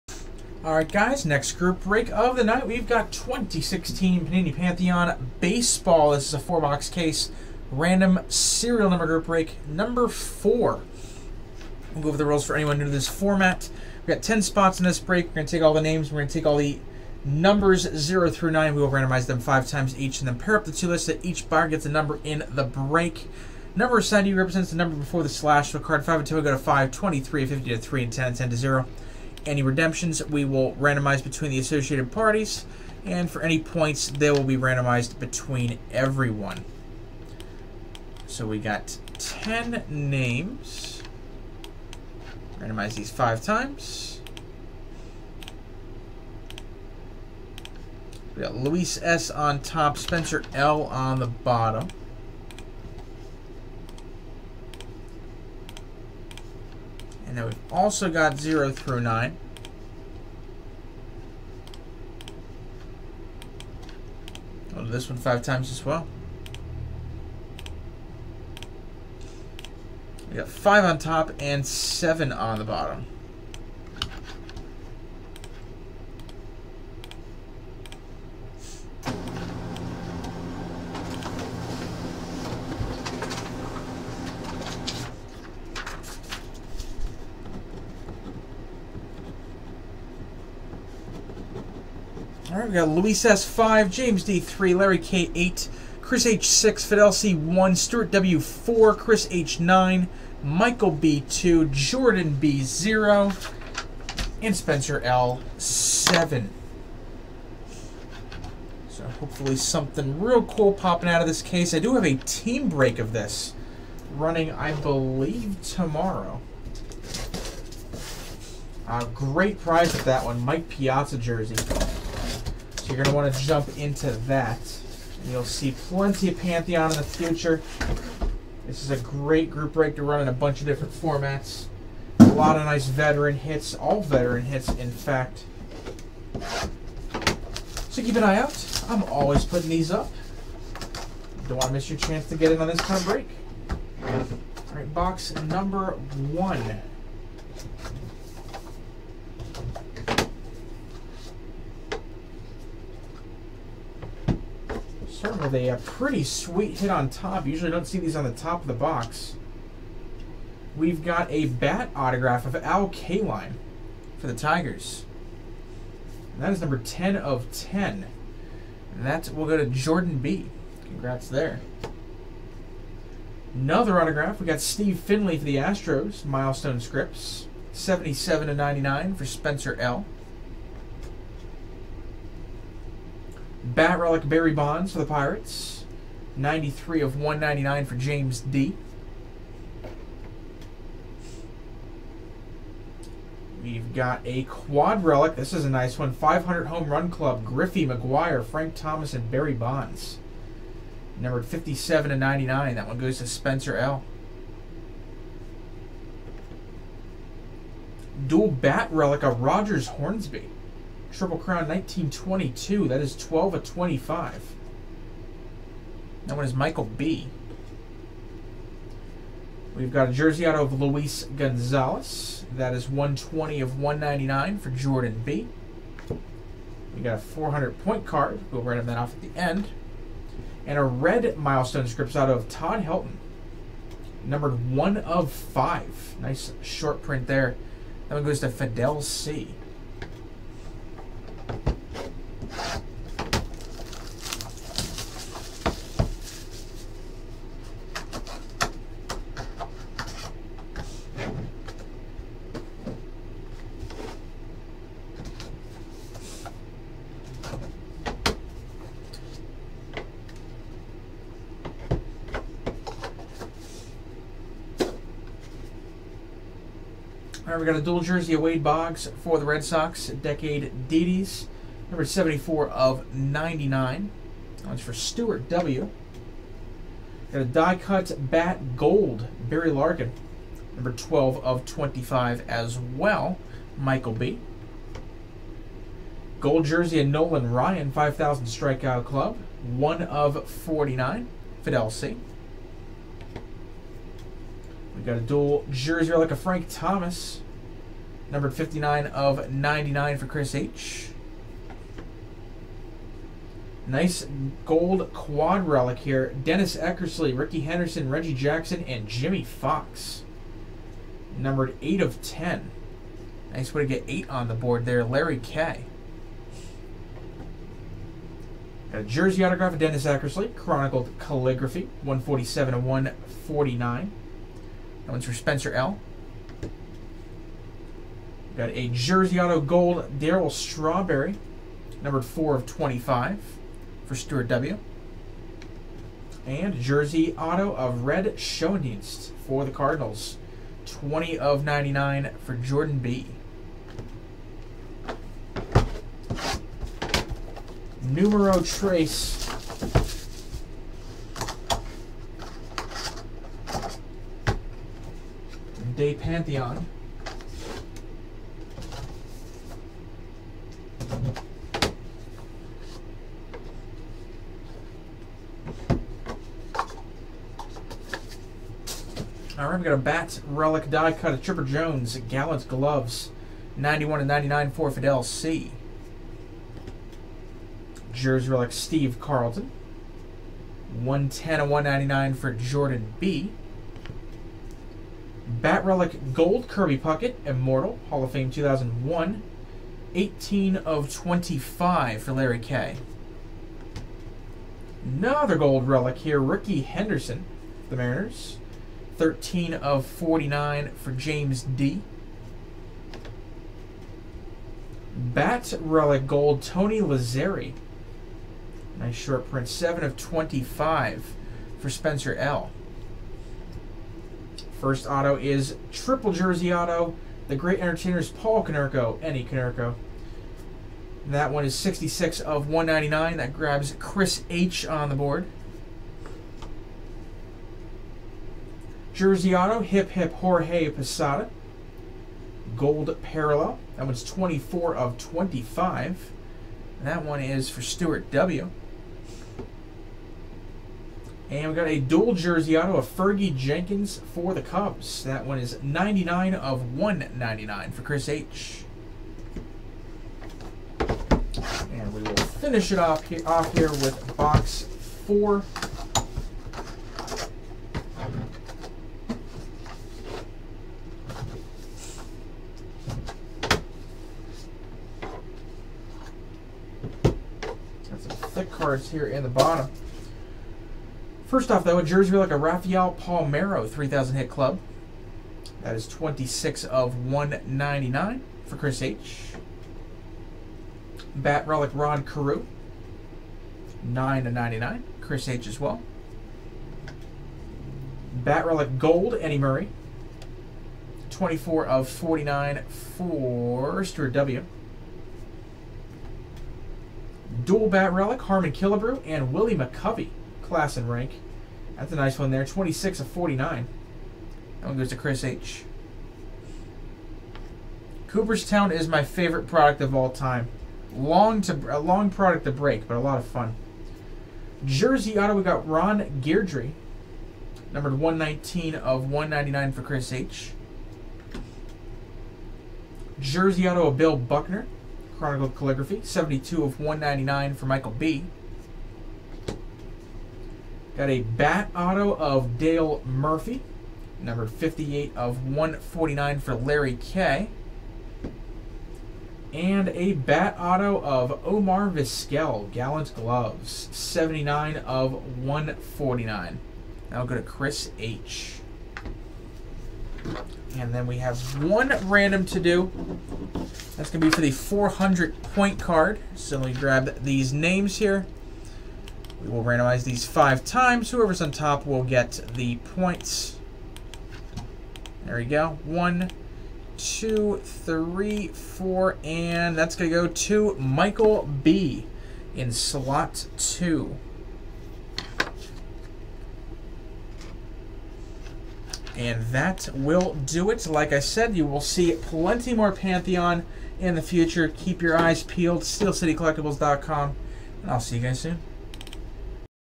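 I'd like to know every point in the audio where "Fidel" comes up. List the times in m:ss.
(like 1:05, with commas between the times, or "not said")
1:36, 3:58, 4:51, 6:14.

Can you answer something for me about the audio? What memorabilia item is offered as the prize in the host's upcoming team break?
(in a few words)
Mike Piazza jersey.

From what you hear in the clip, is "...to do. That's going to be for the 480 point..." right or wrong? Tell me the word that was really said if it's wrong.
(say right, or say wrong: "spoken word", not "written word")
wrong: "400", not "480".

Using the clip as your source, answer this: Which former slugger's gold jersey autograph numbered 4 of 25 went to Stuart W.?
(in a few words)
Darryl Strawberry.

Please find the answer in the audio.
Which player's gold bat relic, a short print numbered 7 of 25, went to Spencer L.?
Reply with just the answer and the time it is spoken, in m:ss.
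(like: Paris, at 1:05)
Tony Lazzeri, at 6:46.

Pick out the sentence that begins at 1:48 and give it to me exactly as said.
So hopefully something real cool popping out of this case.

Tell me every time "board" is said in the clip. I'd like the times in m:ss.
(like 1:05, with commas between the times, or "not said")
5:14, 7:05.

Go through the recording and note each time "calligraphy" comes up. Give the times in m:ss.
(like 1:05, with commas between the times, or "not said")
5:21, 8:45.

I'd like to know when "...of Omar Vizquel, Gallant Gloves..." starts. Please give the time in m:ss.
9:01.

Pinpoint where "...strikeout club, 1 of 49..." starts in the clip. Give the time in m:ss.
4:48.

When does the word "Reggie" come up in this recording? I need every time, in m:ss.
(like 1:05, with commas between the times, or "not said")
5:08.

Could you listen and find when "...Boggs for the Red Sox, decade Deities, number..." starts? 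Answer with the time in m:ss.
4:28.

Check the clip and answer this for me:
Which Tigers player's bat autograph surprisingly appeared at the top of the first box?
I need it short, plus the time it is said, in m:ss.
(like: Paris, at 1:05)
Al Kaline, at 2:42.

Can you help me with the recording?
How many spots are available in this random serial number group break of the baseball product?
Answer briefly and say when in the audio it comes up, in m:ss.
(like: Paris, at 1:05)
10, at 0:14.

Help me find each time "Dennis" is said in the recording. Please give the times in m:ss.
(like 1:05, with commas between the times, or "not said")
5:06, 5:19.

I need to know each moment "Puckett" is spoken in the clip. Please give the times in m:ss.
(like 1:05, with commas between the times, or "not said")
6:26.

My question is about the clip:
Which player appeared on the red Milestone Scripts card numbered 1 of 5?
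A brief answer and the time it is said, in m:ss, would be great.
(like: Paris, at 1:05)
Todd Helton, at 3:52.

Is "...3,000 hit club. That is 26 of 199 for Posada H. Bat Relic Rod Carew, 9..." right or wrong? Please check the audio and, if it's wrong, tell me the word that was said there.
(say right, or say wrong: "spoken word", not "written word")
wrong: "Chris", not "Posada".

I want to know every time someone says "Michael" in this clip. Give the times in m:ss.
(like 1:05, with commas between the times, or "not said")
1:40, 3:36, 4:43, 8:47, 9:30.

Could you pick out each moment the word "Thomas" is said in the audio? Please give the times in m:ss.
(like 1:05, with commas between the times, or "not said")
3:18, 4:56.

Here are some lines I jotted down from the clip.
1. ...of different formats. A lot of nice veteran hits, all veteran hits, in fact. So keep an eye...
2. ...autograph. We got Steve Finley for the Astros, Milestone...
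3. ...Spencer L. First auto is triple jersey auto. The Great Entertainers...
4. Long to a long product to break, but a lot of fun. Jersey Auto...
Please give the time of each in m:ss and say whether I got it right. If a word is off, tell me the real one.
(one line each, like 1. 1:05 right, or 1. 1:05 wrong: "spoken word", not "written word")
1. 2:10 right
2. 2:54 right
3. 6:51 right
4. 8:31 right.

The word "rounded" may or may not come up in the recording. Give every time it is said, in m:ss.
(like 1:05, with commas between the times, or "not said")
not said.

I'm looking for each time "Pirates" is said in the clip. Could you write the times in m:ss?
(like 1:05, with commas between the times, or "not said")
3:05.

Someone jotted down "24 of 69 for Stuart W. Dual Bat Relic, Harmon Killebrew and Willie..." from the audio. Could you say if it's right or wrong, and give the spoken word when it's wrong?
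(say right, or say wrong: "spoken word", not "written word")
wrong: "49", not "69".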